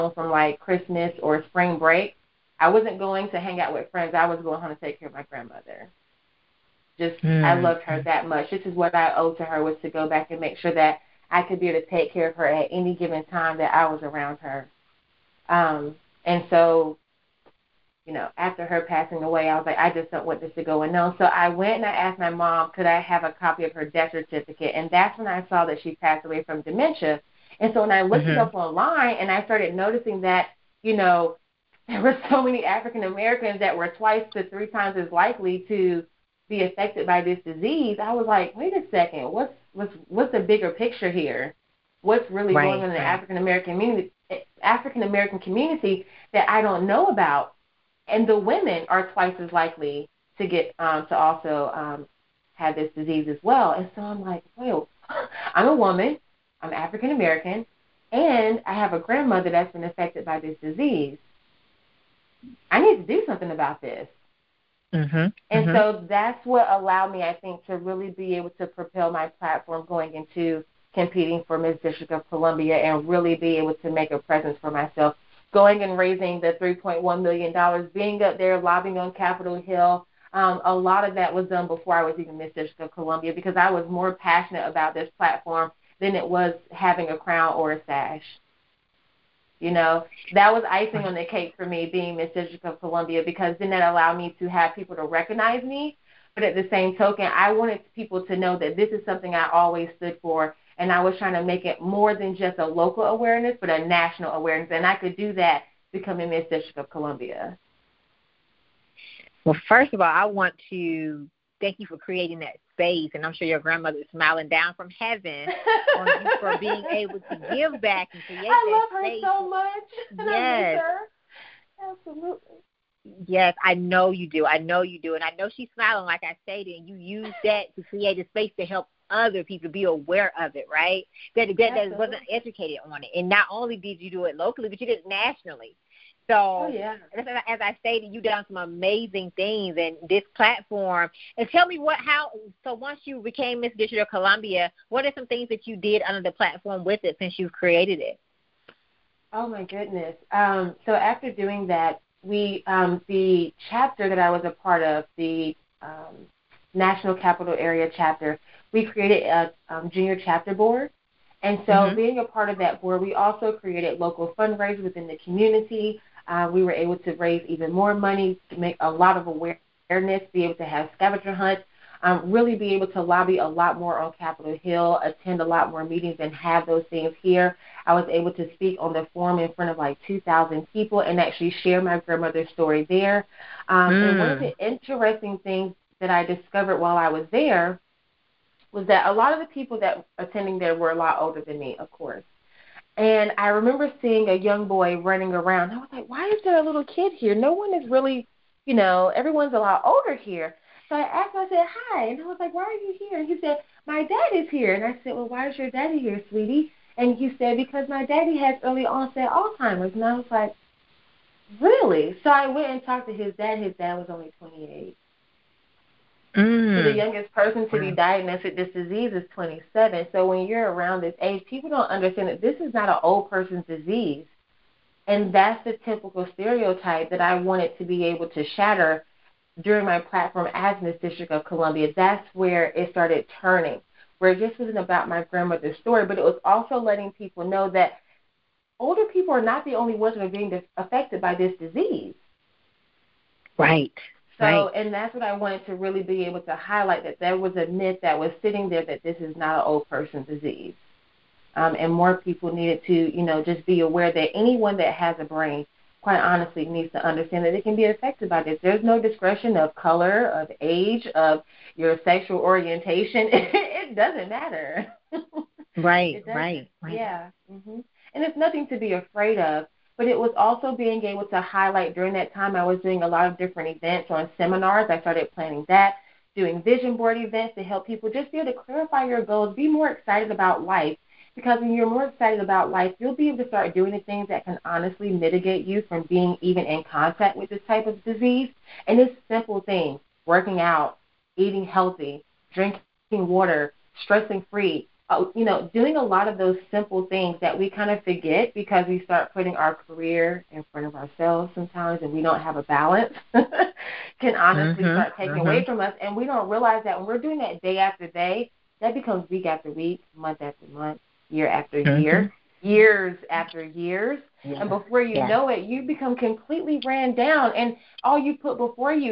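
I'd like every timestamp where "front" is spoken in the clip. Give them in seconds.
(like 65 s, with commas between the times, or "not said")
179 s, 300 s.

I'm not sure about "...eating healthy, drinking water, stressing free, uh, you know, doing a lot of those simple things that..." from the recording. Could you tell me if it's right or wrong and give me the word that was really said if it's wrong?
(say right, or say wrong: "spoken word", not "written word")
right.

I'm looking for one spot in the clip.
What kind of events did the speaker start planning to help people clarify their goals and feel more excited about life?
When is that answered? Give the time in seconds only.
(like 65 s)
276 s.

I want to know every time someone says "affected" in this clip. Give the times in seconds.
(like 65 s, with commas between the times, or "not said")
36 s, 59 s, 240 s, 257 s.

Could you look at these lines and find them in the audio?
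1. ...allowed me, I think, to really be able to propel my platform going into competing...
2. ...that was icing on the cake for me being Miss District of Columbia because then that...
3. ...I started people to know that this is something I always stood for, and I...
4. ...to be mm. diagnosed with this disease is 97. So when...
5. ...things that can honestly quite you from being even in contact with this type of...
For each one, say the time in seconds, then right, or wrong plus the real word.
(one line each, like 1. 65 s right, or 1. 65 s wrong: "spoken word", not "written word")
1. 66 s right
2. 90 s right
3. 97 s wrong: "wanted", not "started"
4. 217 s wrong: "27", not "97"
5. 284 s wrong: "mitigate", not "quite".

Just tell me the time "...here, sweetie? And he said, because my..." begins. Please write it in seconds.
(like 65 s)
205 s.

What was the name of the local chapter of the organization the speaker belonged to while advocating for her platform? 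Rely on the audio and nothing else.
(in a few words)
National Capital Area.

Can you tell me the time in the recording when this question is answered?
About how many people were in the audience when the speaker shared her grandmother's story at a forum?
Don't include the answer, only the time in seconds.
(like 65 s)
180 s.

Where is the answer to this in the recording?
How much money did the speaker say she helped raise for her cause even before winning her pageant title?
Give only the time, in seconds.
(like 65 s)
76 s.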